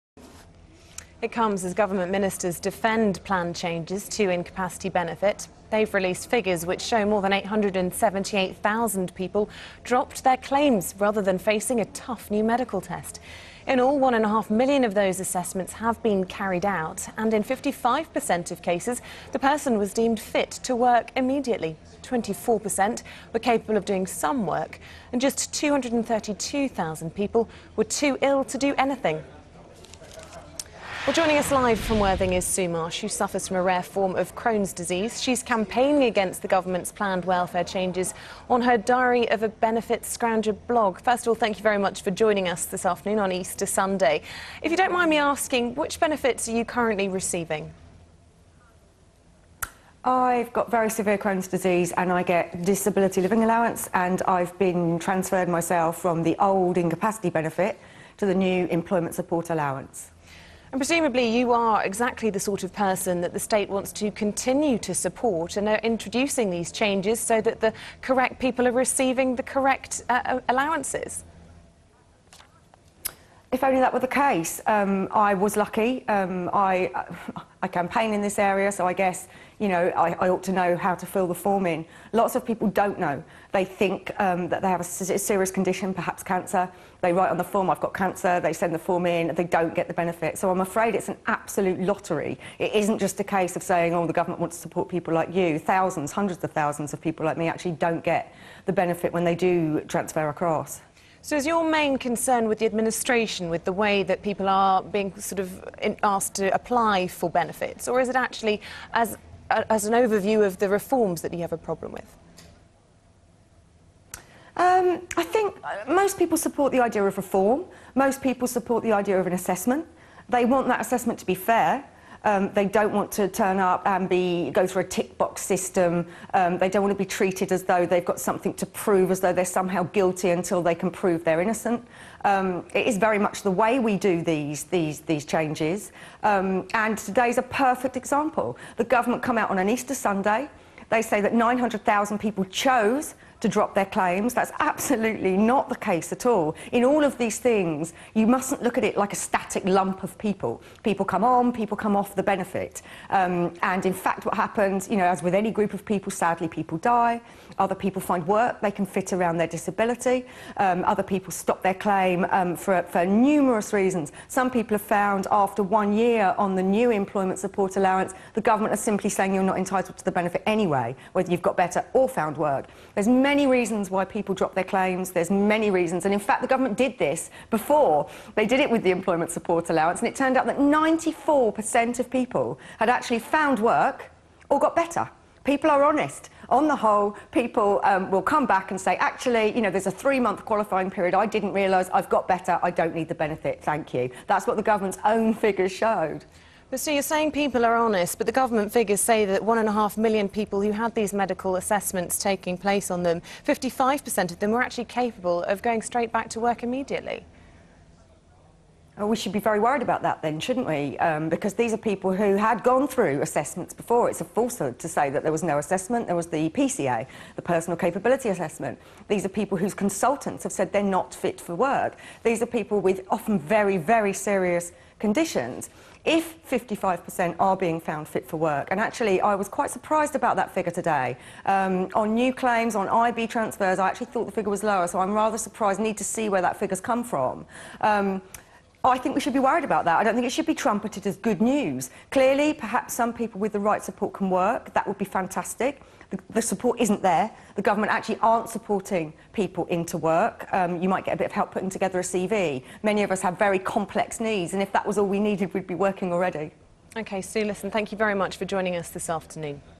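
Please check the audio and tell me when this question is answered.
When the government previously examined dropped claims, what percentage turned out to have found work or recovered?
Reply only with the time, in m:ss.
3:00.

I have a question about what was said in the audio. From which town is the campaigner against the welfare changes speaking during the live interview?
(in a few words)
Worthing.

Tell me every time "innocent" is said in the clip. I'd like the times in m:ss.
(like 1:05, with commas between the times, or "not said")
2:11.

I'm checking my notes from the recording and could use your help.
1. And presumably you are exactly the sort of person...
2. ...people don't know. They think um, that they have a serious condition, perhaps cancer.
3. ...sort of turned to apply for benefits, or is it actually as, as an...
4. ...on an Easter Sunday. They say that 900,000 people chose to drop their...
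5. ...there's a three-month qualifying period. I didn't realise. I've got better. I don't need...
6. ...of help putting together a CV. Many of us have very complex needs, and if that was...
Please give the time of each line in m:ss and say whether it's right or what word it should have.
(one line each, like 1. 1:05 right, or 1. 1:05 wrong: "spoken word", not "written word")
1. 1:00 right
2. 1:22 right
3. 1:45 wrong: "asked", not "turned"
4. 2:19 right
5. 3:09 right
6. 4:11 right.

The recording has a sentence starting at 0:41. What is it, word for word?
First of all, thank you very much for joining us this afternoon on Easter Sunday.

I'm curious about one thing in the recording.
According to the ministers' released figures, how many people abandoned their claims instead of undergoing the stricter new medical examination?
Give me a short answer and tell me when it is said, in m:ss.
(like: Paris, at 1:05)
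878,000, at 0:07.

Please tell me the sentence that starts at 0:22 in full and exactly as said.
24% were capable of doing some work, and just 232,000 people were too ill to do anything.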